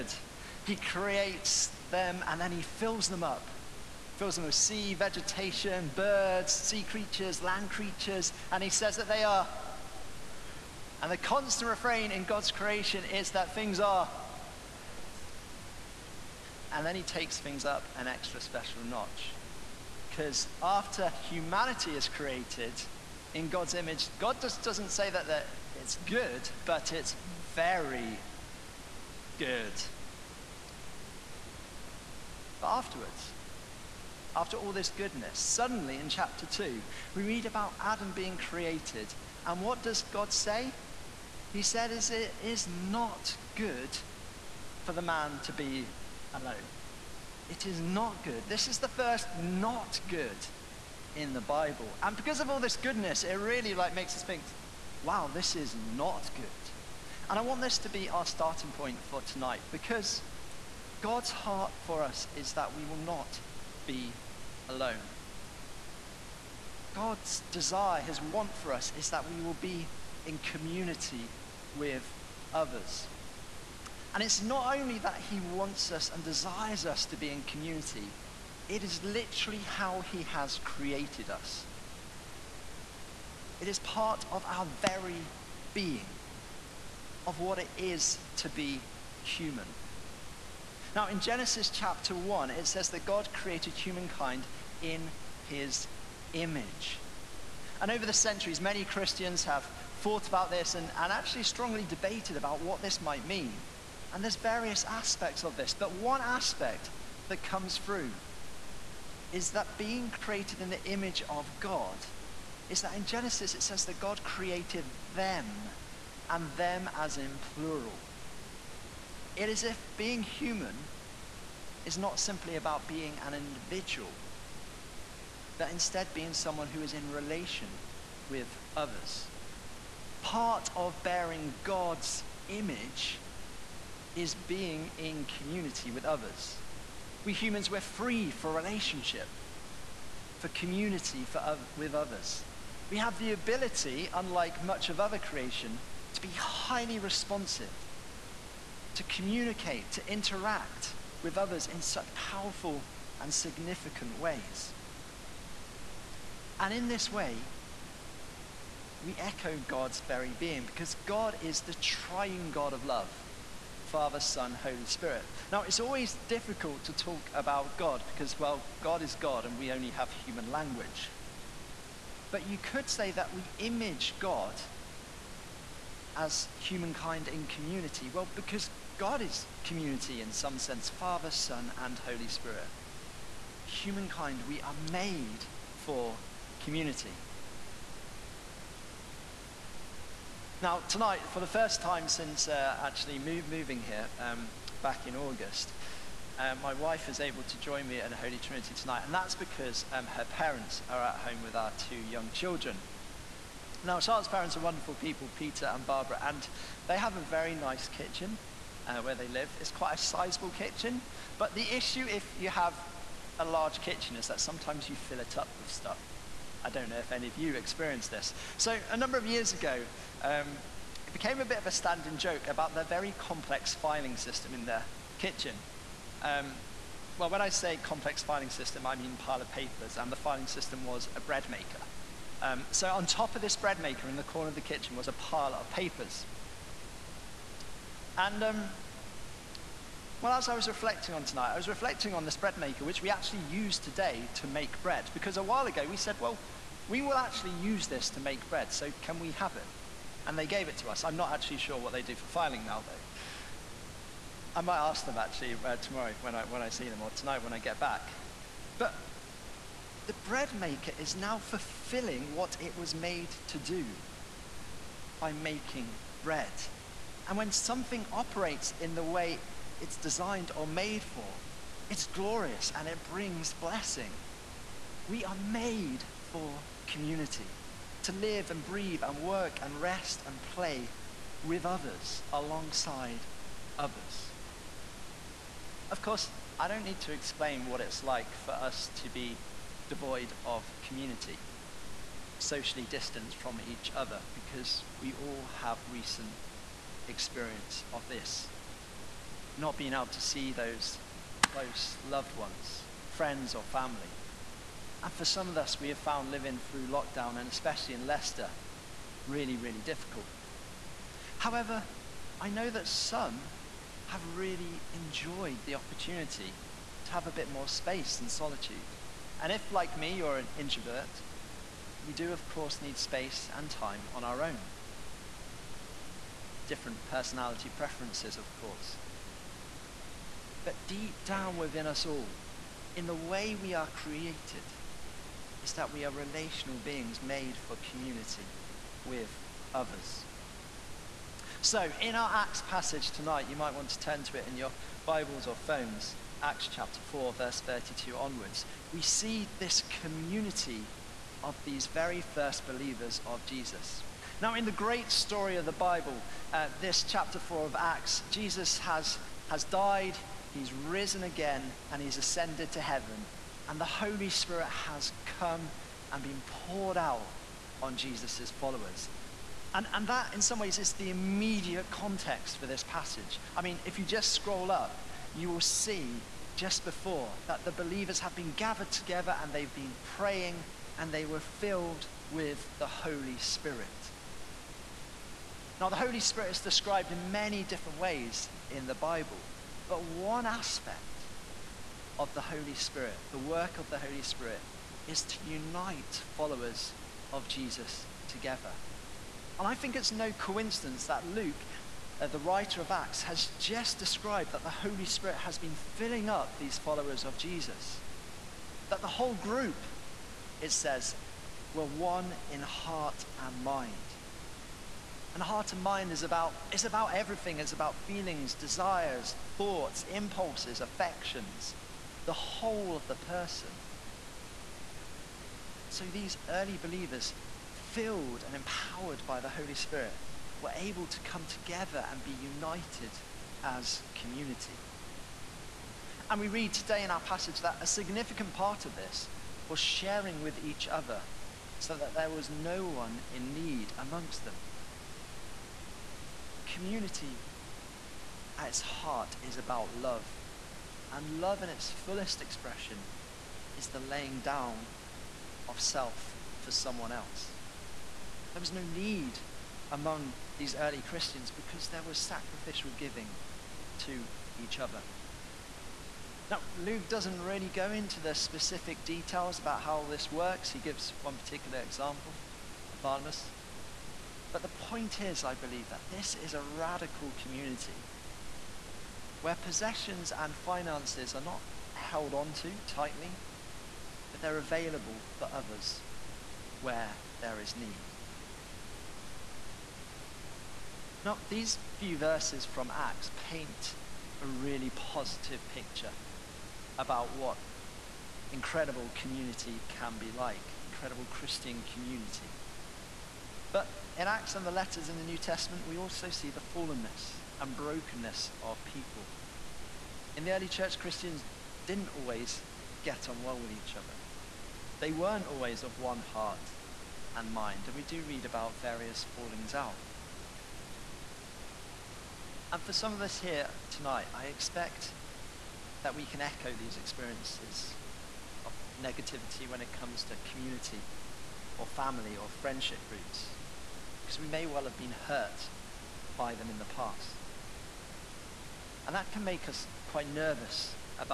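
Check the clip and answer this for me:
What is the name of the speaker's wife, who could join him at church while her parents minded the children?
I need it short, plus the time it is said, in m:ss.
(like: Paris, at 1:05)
Charlotte, at 3:24.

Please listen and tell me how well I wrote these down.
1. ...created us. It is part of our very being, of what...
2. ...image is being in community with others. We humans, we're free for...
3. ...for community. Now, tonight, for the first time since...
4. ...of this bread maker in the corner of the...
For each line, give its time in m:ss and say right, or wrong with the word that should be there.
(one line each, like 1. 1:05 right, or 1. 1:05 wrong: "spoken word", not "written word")
1. 1:20 right
2. 2:12 right
3. 3:05 right
4. 3:53 right.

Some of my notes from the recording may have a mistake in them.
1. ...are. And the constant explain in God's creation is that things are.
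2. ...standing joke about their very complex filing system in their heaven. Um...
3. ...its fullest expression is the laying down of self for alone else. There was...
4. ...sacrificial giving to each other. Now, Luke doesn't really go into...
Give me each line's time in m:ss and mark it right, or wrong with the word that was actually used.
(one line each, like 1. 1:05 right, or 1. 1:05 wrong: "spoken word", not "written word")
1. 0:09 wrong: "refrain", not "explain"
2. 3:41 wrong: "kitchen", not "heaven"
3. 7:31 wrong: "someone", not "alone"
4. 7:42 right.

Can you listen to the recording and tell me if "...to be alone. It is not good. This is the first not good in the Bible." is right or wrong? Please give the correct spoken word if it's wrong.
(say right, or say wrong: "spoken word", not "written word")
right.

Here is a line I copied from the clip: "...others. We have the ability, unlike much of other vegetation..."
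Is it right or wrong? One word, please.
wrong.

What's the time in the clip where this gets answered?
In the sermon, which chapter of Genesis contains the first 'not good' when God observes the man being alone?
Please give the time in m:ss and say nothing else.
0:36.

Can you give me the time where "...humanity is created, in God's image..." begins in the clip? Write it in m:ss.
0:21.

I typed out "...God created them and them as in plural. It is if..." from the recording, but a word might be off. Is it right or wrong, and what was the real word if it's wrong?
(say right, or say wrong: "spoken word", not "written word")
right.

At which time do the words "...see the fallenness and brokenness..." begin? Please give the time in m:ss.
8:26.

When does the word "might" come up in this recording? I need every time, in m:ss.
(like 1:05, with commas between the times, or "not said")
1:43, 4:14, 5:43.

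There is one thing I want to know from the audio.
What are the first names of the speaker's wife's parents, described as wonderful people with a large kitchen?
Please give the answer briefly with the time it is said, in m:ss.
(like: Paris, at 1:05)
Peter and Barbara, at 3:25.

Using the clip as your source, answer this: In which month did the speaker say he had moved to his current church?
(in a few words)
August.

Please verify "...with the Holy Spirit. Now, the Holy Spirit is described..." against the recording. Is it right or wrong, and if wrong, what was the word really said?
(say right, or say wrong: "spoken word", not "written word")
right.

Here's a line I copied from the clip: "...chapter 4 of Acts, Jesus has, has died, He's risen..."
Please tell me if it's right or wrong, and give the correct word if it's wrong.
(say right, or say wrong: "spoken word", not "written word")
right.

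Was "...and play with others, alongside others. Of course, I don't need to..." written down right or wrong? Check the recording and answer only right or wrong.
right.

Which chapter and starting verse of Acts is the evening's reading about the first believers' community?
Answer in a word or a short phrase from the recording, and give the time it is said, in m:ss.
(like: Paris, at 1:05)
Acts 4:32, at 5:46.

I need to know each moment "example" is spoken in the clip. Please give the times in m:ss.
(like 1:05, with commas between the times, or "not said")
7:51.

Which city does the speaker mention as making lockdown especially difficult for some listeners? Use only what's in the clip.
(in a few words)
Leicester.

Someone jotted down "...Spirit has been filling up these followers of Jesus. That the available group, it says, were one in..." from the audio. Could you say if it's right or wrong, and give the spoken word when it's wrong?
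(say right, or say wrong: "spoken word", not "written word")
wrong: "whole", not "available".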